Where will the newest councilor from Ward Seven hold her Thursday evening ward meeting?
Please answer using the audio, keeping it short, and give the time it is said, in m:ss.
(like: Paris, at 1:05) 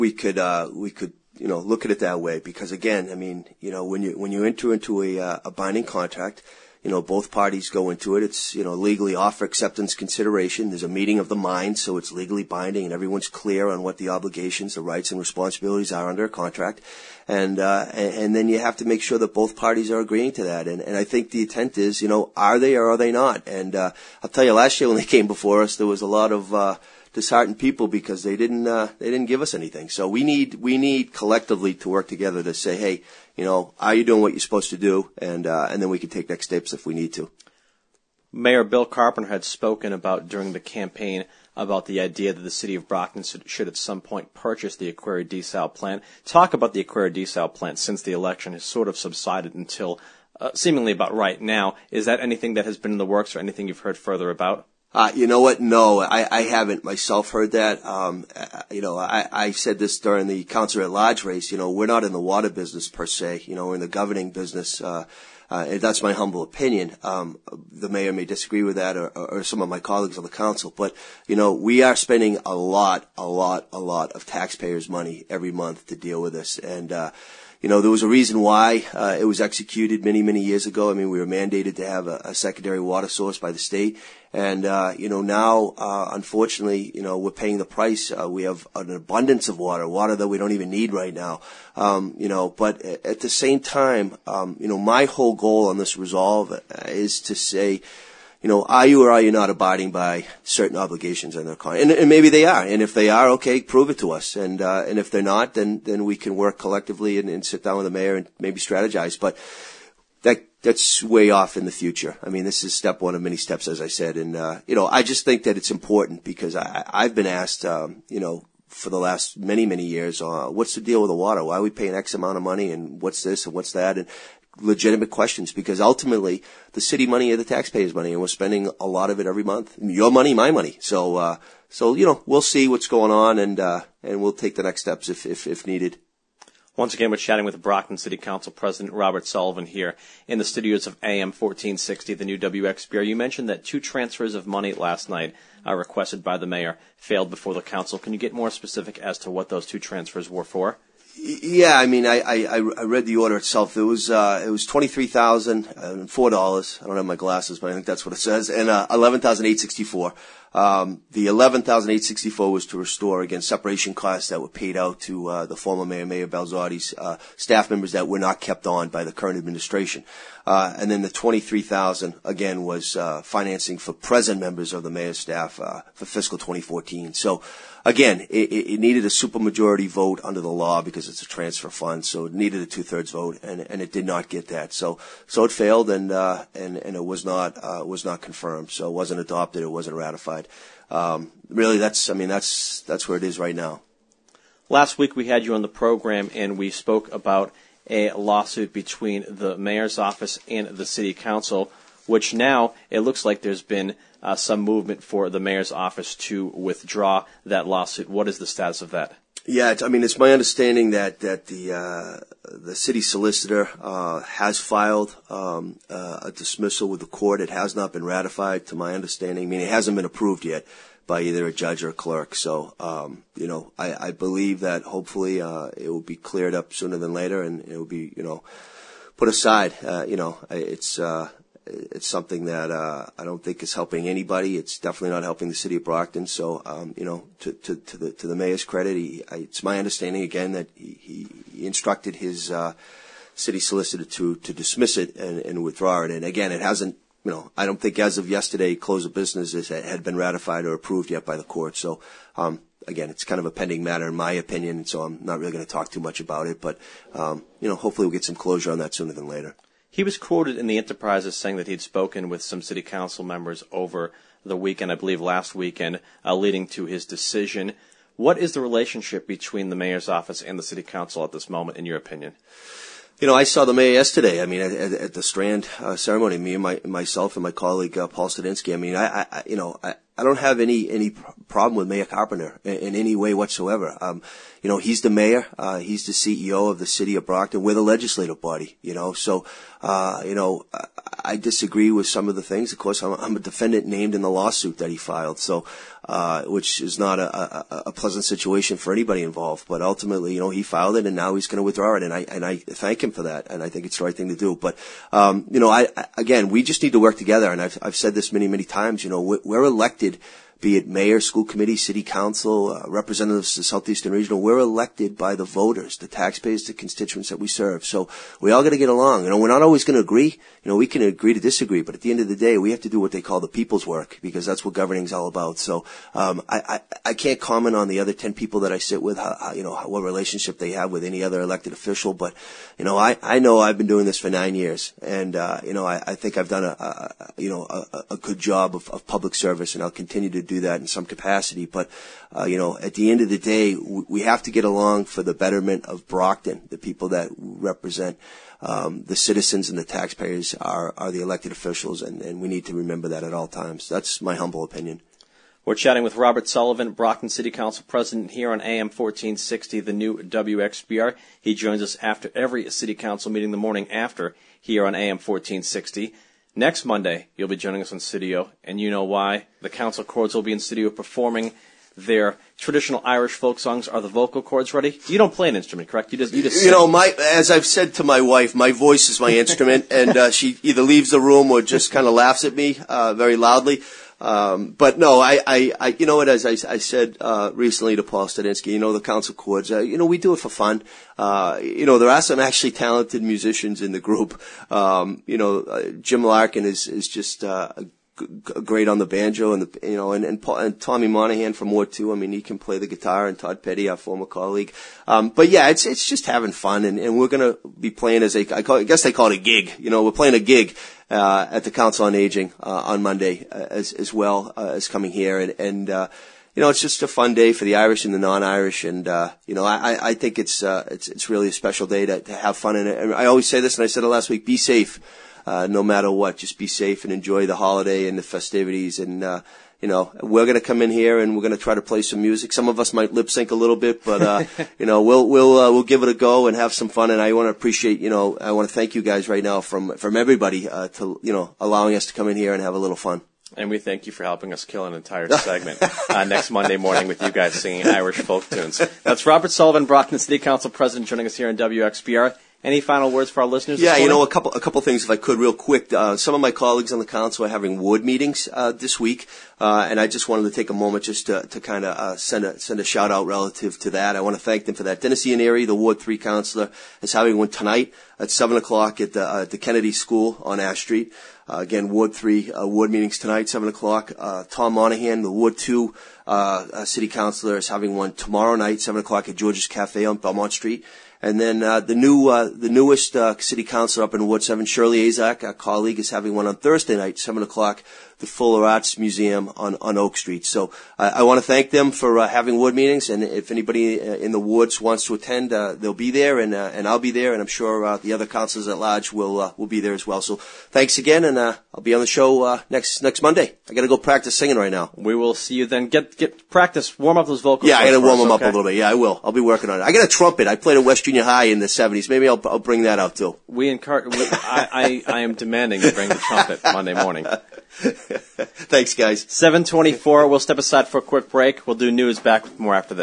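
Fuller Arts Museum, at 8:08.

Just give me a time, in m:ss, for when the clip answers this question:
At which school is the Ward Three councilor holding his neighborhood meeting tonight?
7:49.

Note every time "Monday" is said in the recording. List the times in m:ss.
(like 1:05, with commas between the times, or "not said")
6:06, 6:53, 7:26, 8:23, 8:36.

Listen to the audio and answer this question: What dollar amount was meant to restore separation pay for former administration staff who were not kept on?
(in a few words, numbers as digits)
$11,864.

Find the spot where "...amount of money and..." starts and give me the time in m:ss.
2:02.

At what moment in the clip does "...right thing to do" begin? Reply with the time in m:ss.
5:04.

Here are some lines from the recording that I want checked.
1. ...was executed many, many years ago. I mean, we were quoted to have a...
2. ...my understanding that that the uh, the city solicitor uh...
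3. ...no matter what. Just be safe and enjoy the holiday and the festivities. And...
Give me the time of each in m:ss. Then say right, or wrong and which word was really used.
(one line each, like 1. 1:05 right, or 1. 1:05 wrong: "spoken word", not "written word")
1. 1:19 wrong: "mandated", not "quoted"
2. 3:30 right
3. 7:05 right.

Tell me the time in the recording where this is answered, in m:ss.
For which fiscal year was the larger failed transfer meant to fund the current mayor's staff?
2:56.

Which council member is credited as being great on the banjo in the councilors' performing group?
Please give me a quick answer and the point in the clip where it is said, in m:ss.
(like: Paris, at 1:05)
Jim Larkin, at 6:35.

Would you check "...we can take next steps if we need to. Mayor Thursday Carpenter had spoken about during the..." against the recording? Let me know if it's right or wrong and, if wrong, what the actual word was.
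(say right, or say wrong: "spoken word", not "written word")
wrong: "Bill", not "Thursday".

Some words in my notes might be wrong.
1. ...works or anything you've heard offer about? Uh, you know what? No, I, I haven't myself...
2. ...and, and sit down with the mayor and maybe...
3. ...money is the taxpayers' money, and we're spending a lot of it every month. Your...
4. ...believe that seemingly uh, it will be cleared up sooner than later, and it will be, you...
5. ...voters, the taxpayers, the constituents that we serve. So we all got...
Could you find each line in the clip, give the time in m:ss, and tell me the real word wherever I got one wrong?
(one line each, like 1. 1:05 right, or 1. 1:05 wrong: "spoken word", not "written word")
1. 0:53 wrong: "further", not "offer"
2. 1:47 right
3. 2:07 right
4. 3:44 wrong: "hopefully", not "seemingly"
5. 5:15 right.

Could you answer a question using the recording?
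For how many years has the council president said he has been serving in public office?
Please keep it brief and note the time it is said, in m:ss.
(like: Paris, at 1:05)
9, at 5:34.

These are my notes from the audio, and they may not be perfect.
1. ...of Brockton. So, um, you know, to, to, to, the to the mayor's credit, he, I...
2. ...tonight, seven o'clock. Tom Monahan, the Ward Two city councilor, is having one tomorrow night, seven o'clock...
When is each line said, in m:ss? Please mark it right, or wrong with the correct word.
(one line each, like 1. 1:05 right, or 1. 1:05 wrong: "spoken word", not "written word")
1. 3:55 right
2. 7:53 right.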